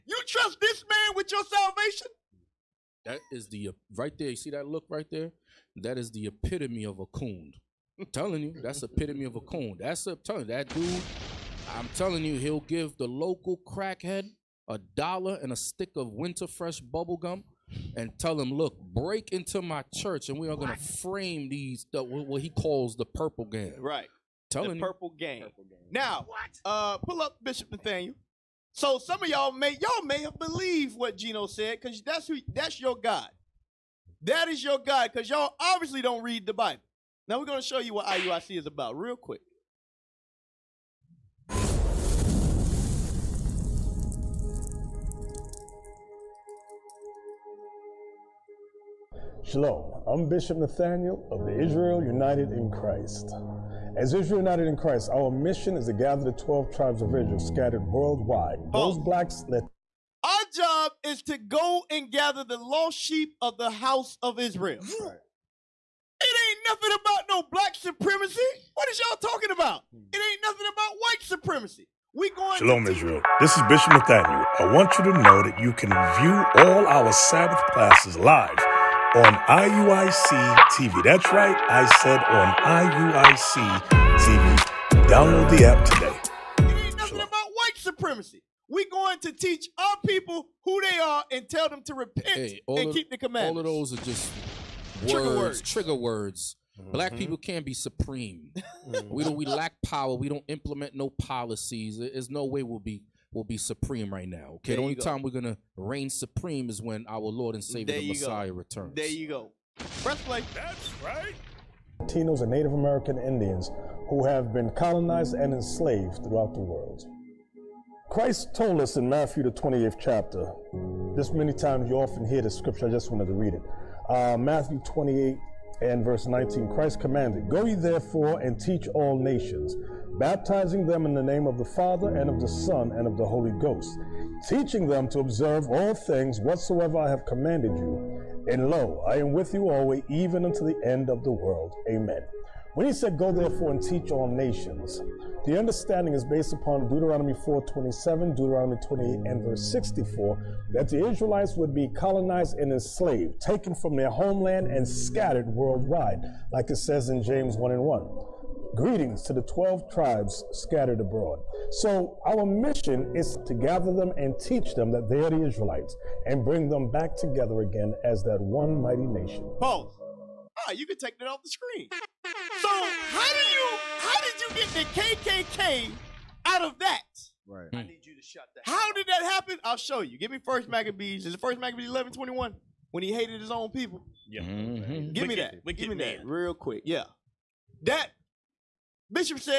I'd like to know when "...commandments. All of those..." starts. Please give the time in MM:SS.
01:33.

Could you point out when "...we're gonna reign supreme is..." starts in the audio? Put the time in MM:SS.
01:45.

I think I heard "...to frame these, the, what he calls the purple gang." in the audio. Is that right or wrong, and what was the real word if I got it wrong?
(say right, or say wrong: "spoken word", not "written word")
right.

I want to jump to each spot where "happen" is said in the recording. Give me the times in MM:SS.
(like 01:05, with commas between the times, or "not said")
02:59.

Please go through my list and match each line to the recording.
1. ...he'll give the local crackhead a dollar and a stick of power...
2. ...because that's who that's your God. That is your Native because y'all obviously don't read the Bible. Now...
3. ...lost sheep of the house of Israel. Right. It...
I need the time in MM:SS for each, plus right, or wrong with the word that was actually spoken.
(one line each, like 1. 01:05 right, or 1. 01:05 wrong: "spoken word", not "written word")
1. 00:12 wrong: "winter", not "power"
2. 00:31 wrong: "God", not "Native"
3. 01:02 right.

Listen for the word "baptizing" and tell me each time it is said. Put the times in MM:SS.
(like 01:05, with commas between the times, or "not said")
02:10.